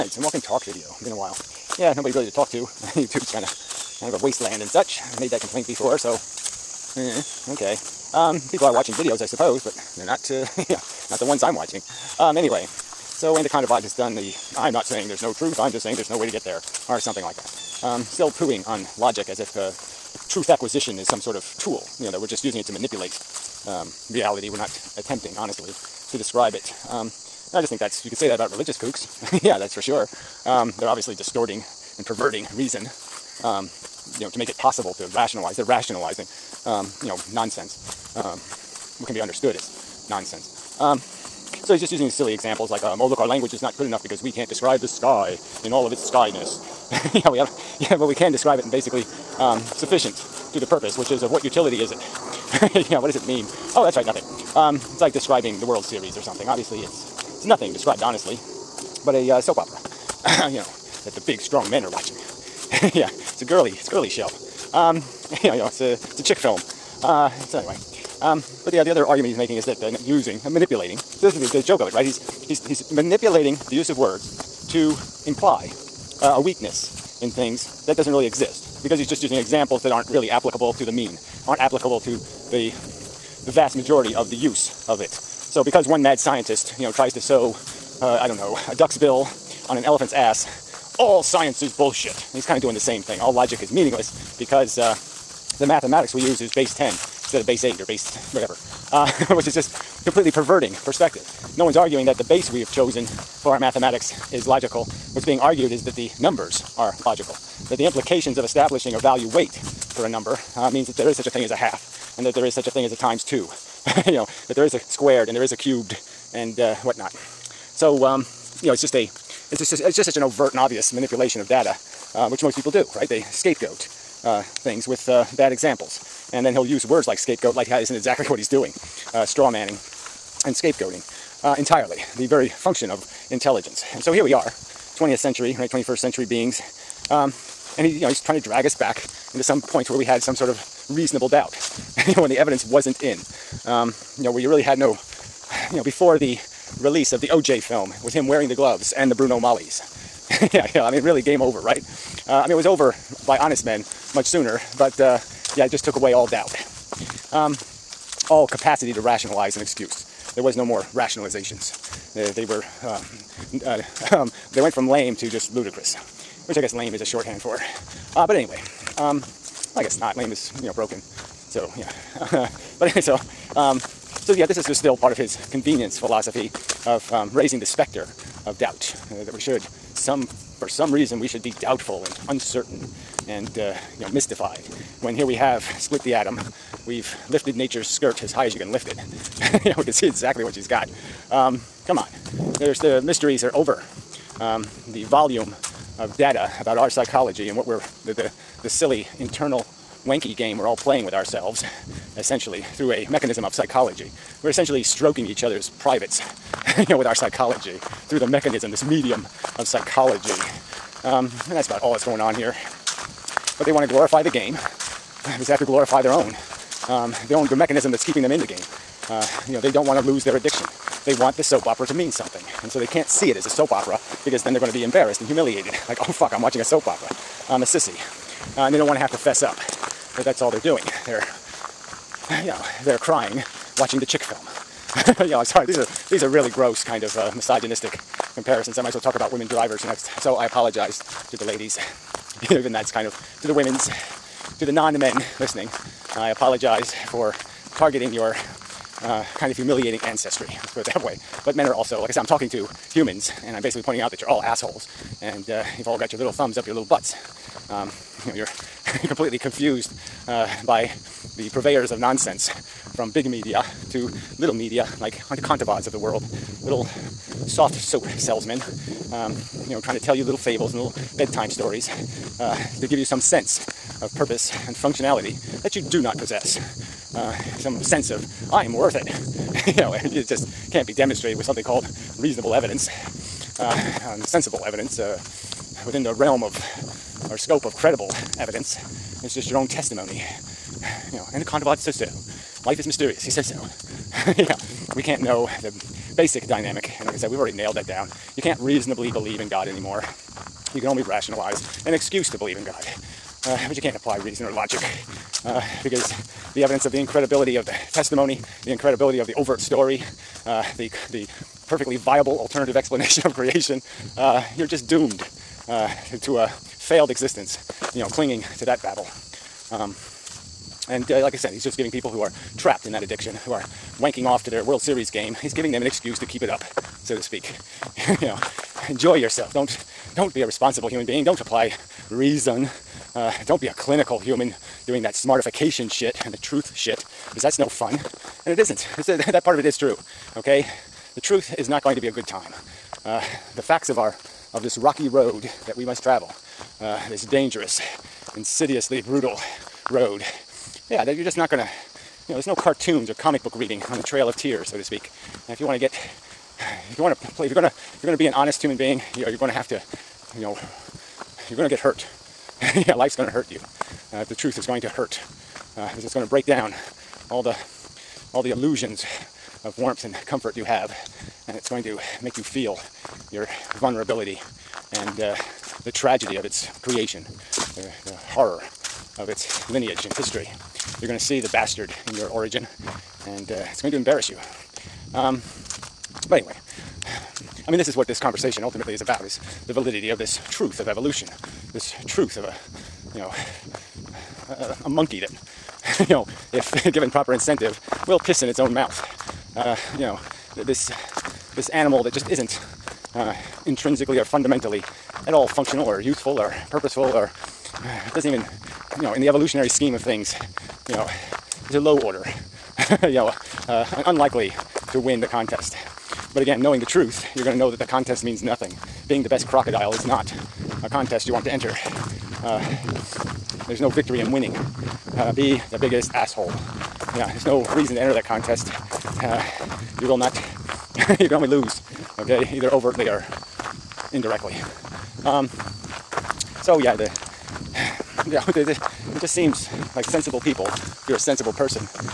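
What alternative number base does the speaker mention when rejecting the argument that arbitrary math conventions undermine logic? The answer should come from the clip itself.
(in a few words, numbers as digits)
base 8.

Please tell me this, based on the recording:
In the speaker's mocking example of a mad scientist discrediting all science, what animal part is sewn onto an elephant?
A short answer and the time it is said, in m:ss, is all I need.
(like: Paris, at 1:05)
a duck's bill, at 1:28.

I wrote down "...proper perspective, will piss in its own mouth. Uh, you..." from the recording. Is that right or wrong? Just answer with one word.
wrong.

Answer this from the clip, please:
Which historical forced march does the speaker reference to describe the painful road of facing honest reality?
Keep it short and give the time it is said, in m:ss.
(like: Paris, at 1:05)
Trail of Tears, at 5:54.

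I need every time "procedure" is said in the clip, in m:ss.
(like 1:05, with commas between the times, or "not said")
not said.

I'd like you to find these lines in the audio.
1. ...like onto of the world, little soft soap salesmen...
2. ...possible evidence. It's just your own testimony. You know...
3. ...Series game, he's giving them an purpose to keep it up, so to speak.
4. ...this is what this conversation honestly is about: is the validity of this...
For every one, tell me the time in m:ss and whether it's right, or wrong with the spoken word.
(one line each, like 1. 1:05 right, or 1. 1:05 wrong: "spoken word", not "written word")
1. 4:24 right
2. 4:47 wrong: "credible", not "possible"
3. 5:24 wrong: "excuse", not "purpose"
4. 6:27 wrong: "ultimately", not "honestly".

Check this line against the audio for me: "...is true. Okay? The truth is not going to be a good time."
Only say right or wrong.
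right.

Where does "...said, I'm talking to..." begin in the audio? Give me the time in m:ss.
4:12.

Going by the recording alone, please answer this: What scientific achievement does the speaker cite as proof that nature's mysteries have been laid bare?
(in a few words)
split the atom.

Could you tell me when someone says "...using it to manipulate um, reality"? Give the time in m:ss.
0:22.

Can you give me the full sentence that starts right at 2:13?
And so here we are, 20th century, right?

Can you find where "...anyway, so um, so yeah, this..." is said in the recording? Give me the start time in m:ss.
2:52.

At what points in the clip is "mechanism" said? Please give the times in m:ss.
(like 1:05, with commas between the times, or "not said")
3:23, 3:28, 3:37.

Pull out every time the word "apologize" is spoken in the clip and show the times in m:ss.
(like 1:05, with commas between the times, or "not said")
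4:00, 4:06.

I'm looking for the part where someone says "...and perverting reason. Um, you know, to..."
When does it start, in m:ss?
0:31.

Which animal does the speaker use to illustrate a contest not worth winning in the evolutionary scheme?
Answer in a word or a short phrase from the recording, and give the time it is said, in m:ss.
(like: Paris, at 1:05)
crocodile, at 6:59.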